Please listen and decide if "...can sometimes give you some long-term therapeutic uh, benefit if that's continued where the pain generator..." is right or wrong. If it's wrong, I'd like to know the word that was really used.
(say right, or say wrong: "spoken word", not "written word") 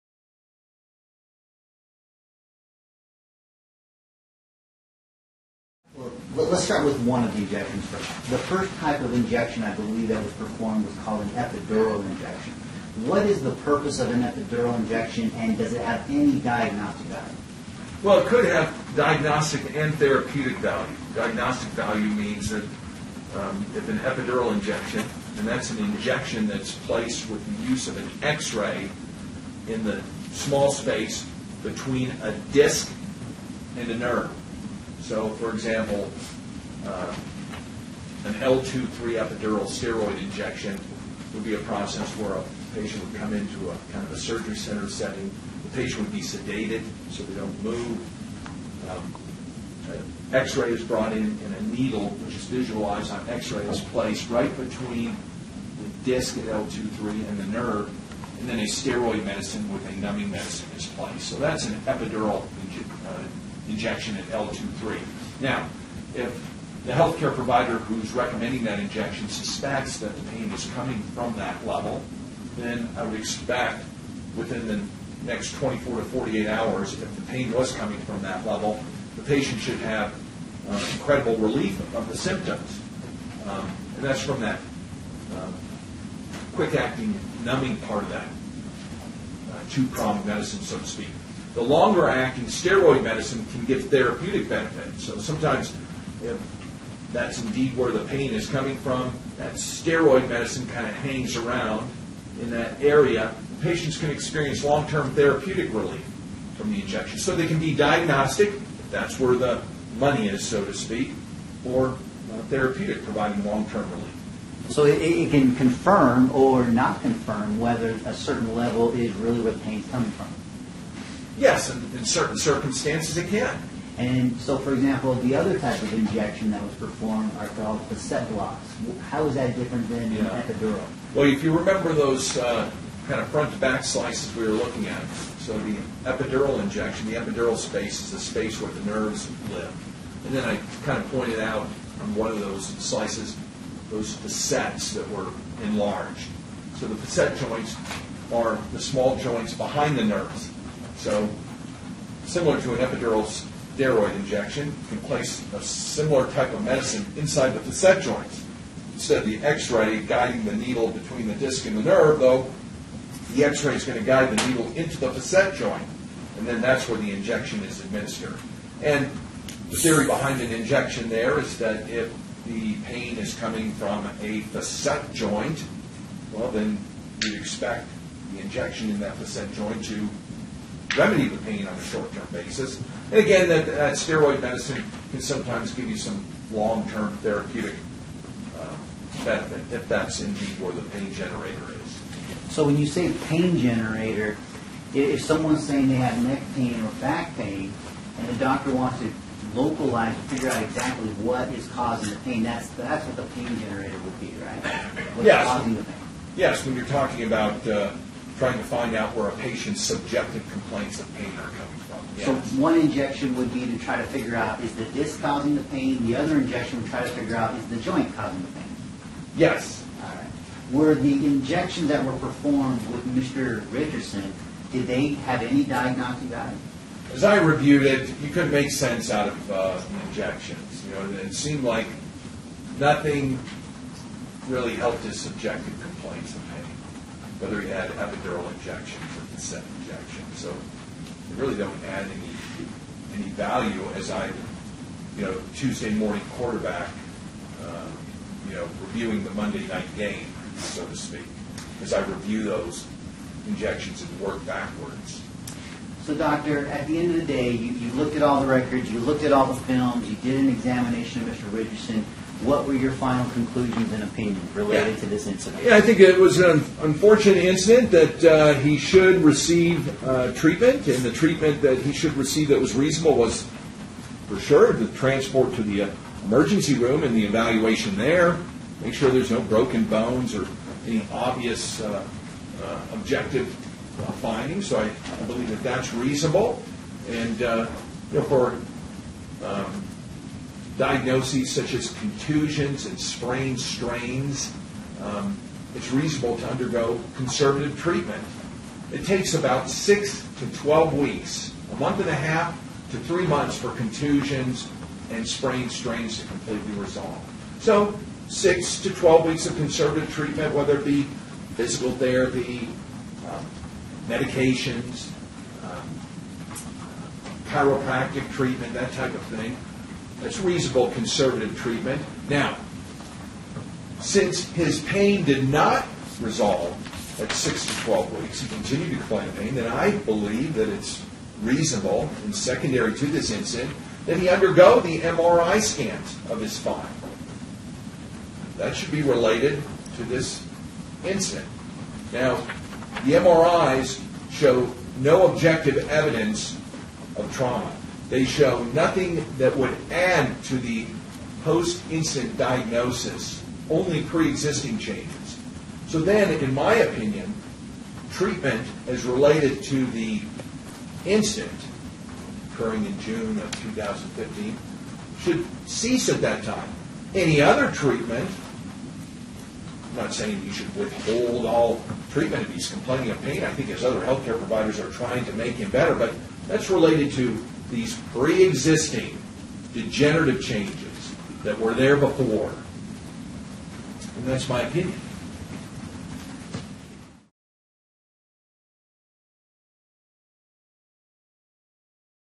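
wrong: "indeed", not "continued".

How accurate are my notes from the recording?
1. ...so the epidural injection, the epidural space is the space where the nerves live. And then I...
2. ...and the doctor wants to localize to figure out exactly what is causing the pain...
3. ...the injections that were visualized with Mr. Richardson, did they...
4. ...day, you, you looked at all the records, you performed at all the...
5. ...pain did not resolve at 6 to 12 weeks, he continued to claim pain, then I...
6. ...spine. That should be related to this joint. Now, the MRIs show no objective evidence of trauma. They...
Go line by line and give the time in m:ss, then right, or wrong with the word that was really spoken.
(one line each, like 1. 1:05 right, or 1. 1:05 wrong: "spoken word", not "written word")
1. 2:15 right
2. 3:18 right
3. 3:40 wrong: "performed", not "visualized"
4. 4:17 wrong: "looked", not "performed"
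5. 5:24 right
6. 5:36 wrong: "incident", not "joint".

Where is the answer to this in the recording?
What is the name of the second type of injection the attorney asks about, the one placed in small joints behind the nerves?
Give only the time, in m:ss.
2:07.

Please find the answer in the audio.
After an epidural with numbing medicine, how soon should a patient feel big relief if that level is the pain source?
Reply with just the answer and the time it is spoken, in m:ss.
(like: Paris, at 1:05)
24 to 48 hours, at 1:15.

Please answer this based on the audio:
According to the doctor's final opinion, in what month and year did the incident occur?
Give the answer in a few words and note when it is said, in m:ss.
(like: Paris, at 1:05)
June 2015, at 6:02.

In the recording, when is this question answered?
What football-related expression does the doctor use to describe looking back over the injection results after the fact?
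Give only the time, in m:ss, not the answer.
4:05.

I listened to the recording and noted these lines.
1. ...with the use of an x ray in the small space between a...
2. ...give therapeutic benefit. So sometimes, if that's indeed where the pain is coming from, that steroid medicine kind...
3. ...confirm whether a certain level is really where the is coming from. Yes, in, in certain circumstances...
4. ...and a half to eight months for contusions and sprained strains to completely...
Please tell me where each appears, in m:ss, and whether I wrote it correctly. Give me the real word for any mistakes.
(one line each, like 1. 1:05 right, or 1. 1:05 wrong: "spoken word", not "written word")
1. 0:27 right
2. 1:33 right
3. 1:57 right
4. 5:01 wrong: "three", not "eight".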